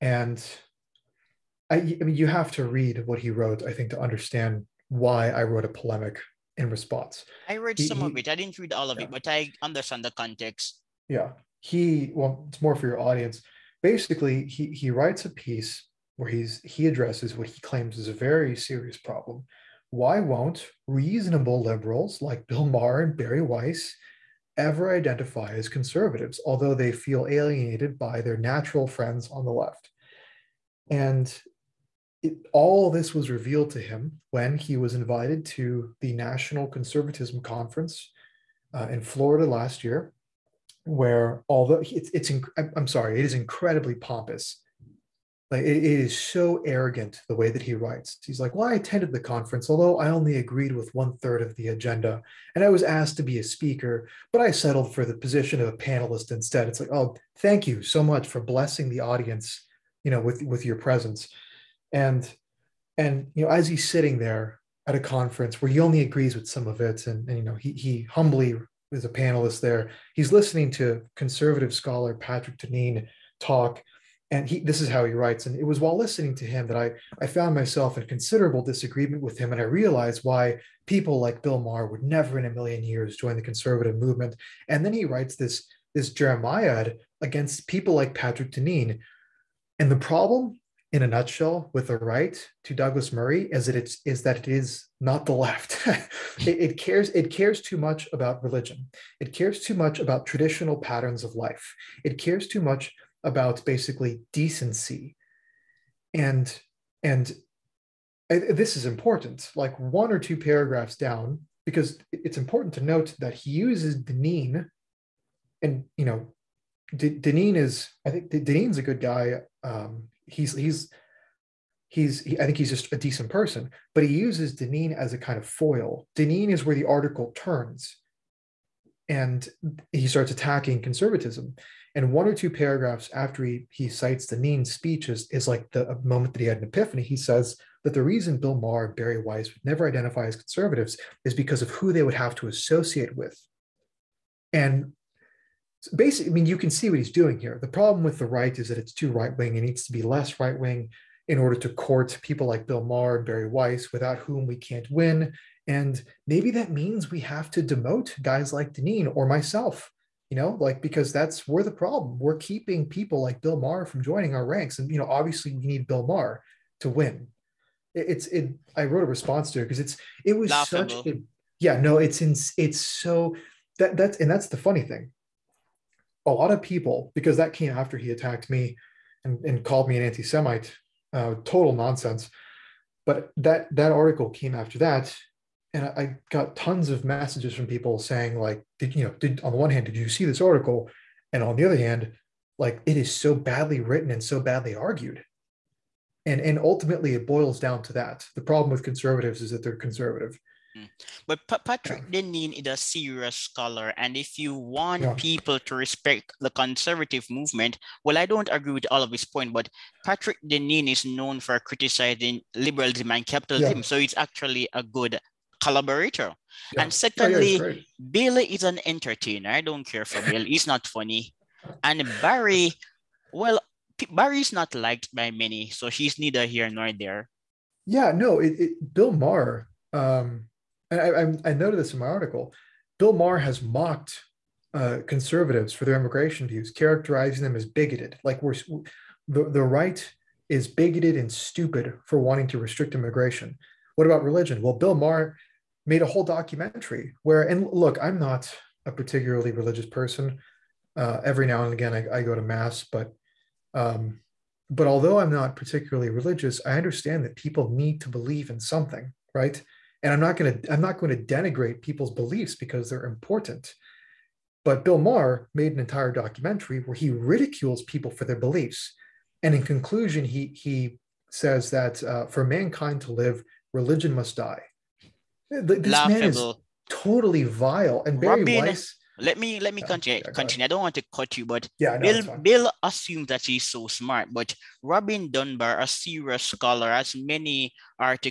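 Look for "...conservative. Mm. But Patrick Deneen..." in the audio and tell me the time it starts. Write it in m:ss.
3:19.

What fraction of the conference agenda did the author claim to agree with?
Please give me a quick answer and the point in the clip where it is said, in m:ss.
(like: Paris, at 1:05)
one third, at 0:50.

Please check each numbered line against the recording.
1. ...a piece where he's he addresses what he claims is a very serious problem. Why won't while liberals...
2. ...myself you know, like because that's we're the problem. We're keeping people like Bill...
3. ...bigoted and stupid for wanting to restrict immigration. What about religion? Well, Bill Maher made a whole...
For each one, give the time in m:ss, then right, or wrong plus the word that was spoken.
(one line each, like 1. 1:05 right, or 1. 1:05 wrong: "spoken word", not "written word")
1. 0:15 wrong: "reasonable", not "while"
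2. 2:39 right
3. 4:00 right.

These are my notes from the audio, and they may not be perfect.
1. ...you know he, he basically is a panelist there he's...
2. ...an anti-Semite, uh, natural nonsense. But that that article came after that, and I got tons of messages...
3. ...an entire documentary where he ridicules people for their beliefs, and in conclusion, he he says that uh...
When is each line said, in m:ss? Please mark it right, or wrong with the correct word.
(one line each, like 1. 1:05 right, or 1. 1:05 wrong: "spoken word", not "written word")
1. 1:07 wrong: "humbly", not "basically"
2. 2:59 wrong: "total", not "natural"
3. 4:25 right.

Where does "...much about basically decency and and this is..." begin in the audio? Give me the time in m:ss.
1:42.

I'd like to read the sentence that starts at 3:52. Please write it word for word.
Bill Maher has mocked uh, conservatives for their immigration views, characterizing them as bigoted.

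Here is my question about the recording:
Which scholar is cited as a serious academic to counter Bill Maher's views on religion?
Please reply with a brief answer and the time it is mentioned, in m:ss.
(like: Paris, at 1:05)
Robin Dunbar, at 4:44.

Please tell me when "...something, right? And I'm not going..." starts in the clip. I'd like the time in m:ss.
4:18.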